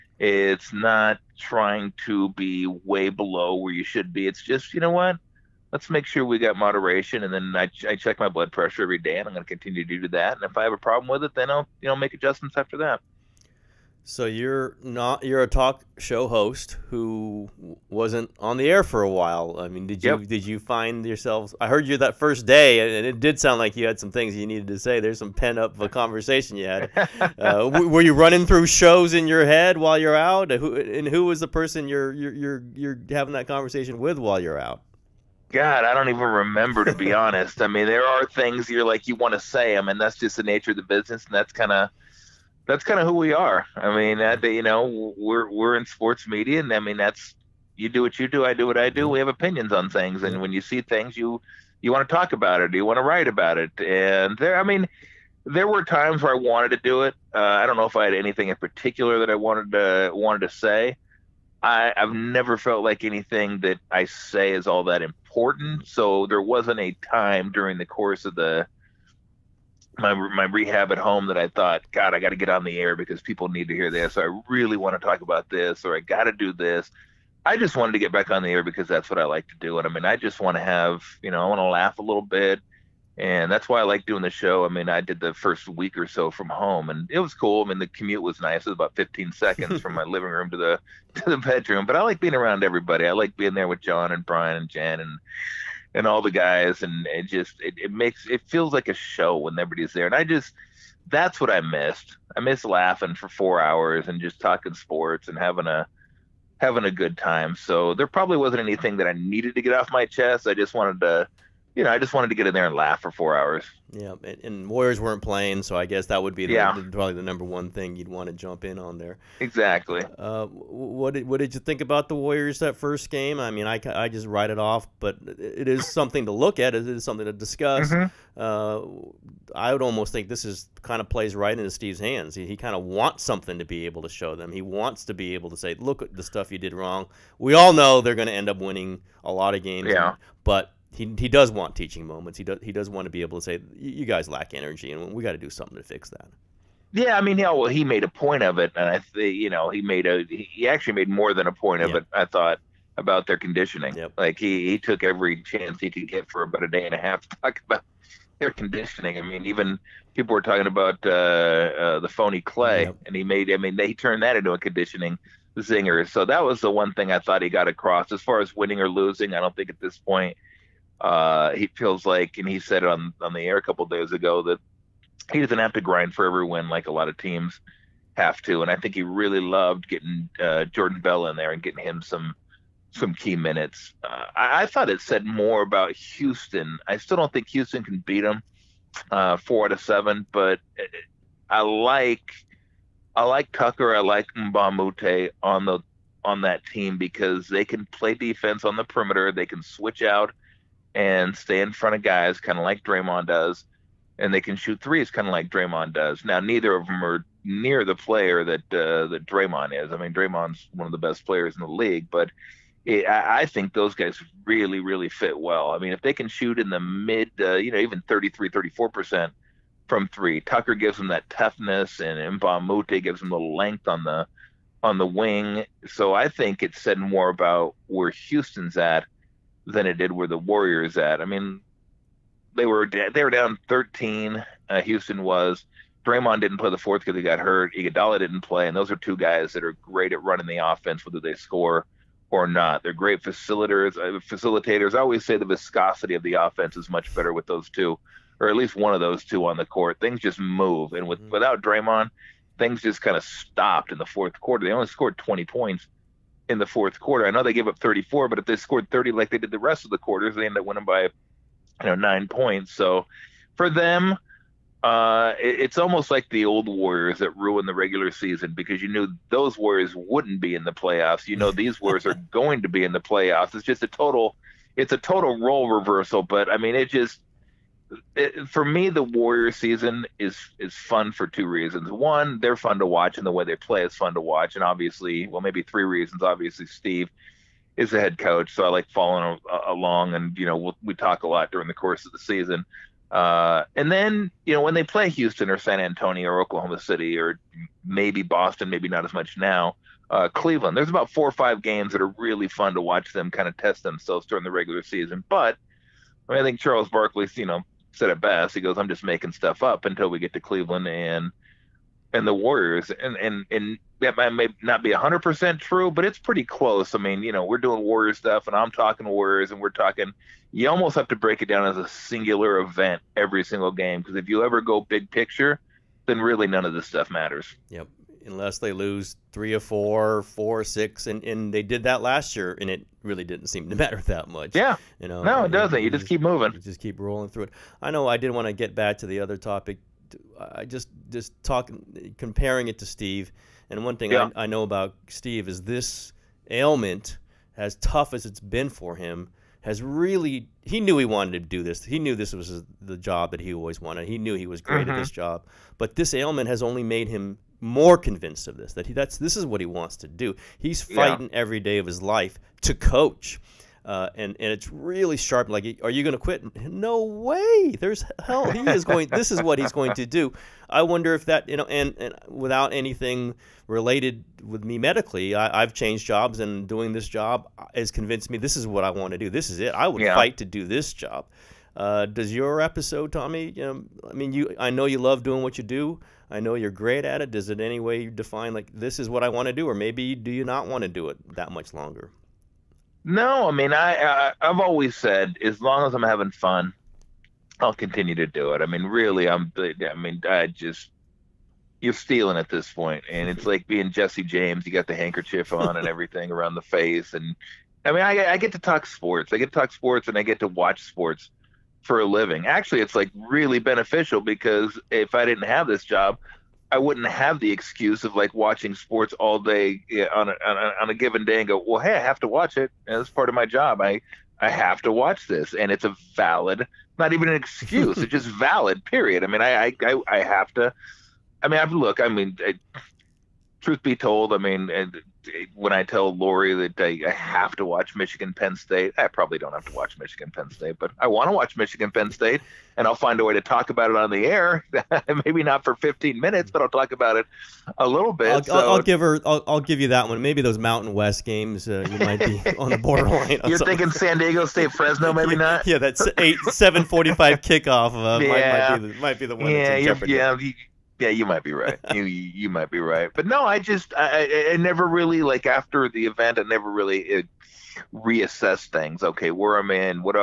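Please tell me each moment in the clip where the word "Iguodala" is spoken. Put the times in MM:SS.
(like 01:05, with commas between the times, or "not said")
03:57.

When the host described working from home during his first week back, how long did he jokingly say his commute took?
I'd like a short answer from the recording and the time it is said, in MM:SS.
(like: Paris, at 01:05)
15 seconds, at 01:28.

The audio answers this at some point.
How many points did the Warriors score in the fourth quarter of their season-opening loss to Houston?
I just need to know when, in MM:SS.
04:15.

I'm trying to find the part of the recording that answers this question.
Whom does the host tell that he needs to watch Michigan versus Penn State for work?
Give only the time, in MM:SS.
07:16.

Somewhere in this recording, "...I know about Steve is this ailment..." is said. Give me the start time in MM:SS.
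05:44.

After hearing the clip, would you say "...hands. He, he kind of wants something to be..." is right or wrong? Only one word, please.
right.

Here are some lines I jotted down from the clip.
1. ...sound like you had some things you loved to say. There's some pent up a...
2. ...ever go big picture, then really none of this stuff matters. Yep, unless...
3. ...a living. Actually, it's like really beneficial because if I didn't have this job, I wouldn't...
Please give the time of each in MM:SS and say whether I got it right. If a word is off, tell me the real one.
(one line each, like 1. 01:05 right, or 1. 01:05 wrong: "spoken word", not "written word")
1. 00:23 wrong: "needed", not "loved"
2. 05:24 right
3. 06:51 right.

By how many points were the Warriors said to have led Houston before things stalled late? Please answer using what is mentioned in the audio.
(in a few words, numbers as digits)
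13.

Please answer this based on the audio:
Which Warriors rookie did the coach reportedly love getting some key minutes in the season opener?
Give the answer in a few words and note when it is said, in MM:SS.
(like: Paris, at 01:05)
Jordan Bell, at 03:00.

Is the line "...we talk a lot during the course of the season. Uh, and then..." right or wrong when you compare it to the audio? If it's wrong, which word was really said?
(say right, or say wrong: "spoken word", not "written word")
right.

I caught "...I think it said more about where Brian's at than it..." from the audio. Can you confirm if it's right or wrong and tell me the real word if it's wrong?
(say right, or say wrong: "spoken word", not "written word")
wrong: "Houston", not "Brian".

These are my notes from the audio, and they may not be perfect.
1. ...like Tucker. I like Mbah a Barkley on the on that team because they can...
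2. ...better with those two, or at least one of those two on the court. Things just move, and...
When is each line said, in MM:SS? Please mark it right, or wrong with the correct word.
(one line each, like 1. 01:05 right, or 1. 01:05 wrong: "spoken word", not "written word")
1. 03:13 wrong: "Moute", not "Barkley"
2. 04:07 right.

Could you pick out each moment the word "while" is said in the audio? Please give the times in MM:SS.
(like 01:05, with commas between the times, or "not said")
00:19, 00:29, 00:34.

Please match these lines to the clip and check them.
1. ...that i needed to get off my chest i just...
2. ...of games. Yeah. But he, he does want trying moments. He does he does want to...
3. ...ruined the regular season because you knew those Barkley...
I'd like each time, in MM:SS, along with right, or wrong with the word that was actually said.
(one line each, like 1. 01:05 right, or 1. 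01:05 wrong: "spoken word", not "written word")
1. 01:48 right
2. 02:19 wrong: "teaching", not "trying"
3. 04:27 wrong: "Warriors", not "Barkley".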